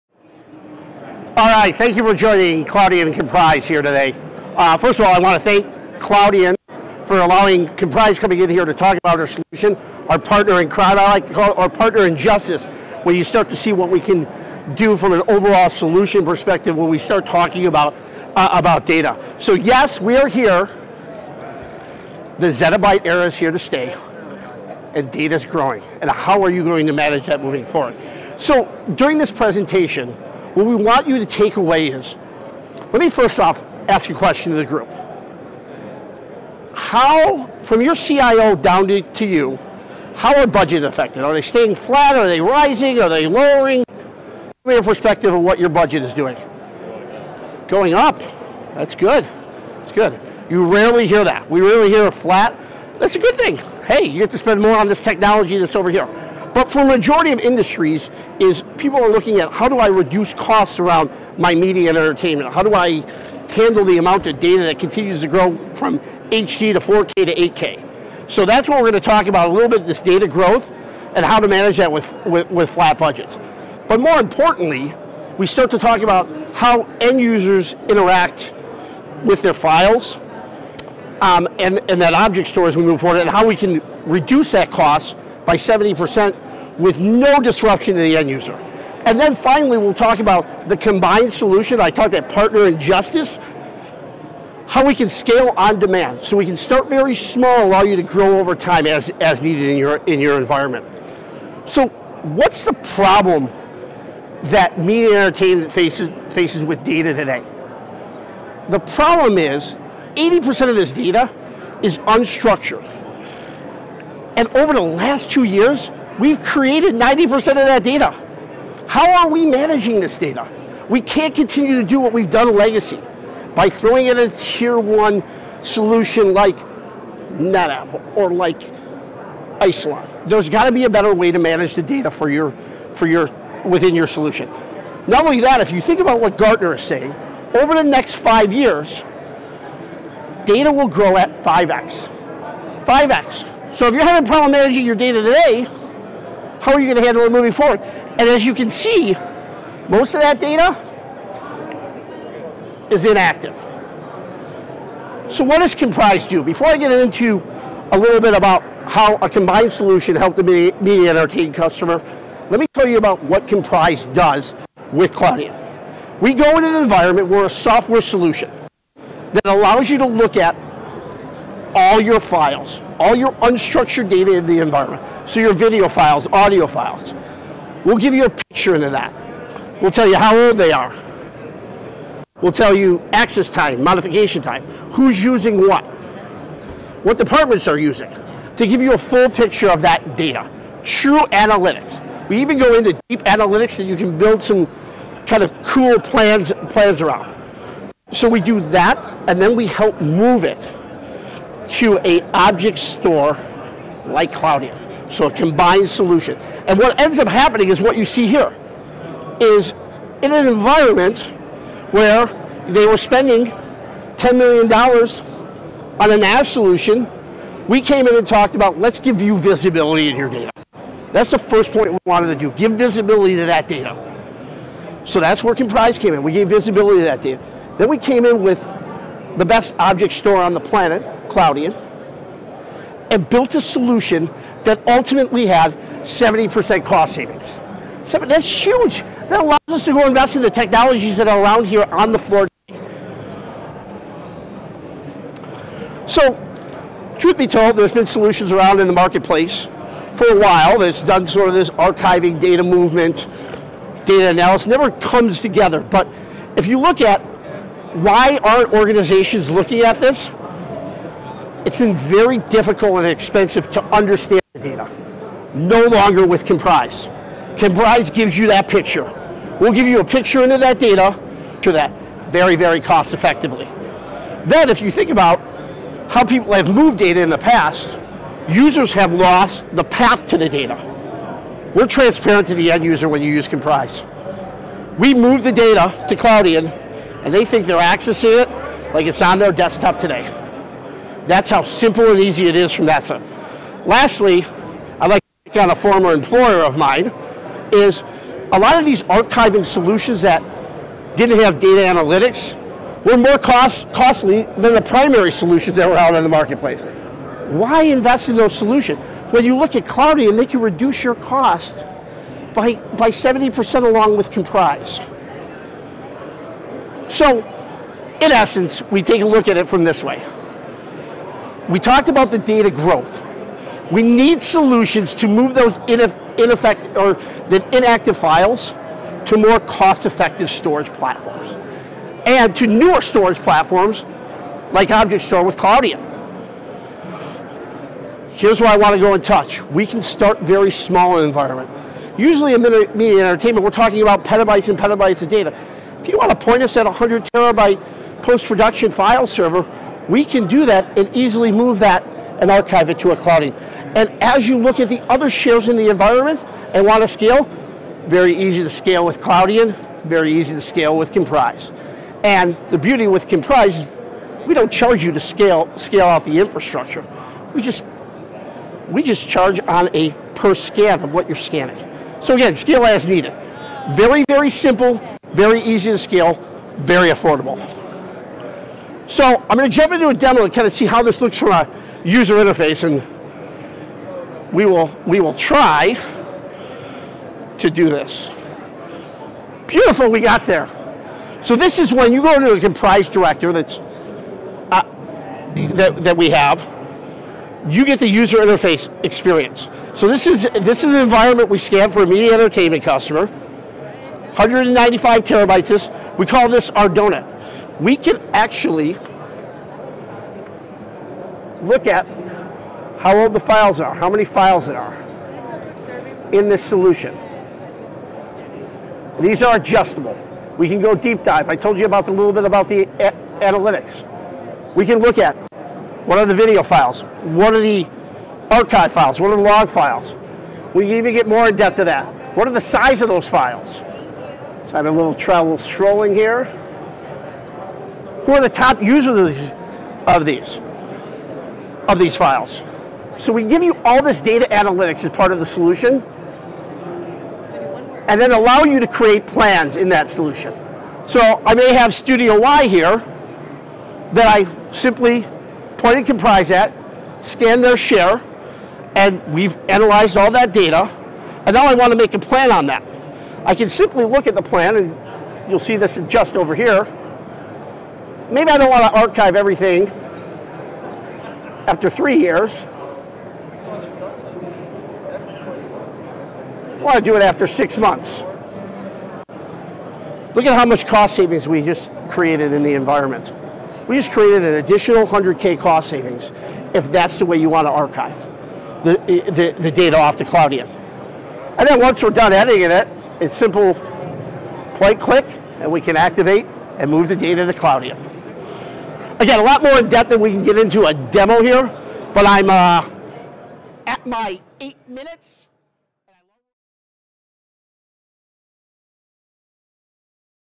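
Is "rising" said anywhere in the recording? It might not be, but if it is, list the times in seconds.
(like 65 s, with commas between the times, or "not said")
42 s.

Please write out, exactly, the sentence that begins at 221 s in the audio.
That's the first point we wanted to do, give visibility to that data.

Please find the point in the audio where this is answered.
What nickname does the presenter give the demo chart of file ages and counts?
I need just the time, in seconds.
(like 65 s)
406 s.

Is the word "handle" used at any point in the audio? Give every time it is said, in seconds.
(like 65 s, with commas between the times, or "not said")
63 s, 147 s.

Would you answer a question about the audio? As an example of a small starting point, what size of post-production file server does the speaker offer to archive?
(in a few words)
100 terabytes.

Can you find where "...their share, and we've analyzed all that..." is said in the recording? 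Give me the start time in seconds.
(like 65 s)
457 s.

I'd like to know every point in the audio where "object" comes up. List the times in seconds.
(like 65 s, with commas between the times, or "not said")
82 s, 202 s, 229 s, 334 s.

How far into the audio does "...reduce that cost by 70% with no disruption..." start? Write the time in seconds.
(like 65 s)
84 s.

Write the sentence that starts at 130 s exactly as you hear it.
There's got to be a better way to manage the data for your, for your, within your solution.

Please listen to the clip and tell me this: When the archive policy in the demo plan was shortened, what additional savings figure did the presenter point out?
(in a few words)
100K.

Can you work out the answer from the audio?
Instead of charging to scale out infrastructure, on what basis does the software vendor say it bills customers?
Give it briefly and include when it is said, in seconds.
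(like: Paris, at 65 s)
per scan, at 370 s.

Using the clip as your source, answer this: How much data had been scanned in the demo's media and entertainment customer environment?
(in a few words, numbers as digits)
195 terabytes.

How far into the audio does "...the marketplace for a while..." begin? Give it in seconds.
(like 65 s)
248 s.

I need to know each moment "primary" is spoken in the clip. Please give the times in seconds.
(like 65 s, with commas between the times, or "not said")
304 s.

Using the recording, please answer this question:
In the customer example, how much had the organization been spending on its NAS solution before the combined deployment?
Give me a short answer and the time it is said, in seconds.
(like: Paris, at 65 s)
$10 million, at 214 s.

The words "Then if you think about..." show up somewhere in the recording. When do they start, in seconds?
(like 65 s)
274 s.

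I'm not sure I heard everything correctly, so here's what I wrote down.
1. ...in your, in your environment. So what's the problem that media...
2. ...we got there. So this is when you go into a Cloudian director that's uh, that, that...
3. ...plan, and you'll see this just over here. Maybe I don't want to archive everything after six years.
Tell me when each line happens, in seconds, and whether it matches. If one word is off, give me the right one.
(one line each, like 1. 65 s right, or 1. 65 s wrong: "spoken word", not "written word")
1. 99 s right
2. 390 s wrong: "Komprise", not "Cloudian"
3. 464 s wrong: "three", not "six".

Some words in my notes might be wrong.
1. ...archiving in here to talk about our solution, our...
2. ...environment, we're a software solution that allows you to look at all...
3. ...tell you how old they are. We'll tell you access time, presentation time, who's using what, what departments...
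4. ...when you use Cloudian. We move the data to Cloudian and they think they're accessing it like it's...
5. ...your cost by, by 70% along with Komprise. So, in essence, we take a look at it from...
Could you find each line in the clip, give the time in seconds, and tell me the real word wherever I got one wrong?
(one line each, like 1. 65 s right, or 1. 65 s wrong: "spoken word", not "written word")
1. 8 s wrong: "coming", not "archiving"
2. 166 s right
3. 179 s wrong: "modification", not "presentation"
4. 283 s wrong: "Komprise", not "Cloudian"
5. 311 s right.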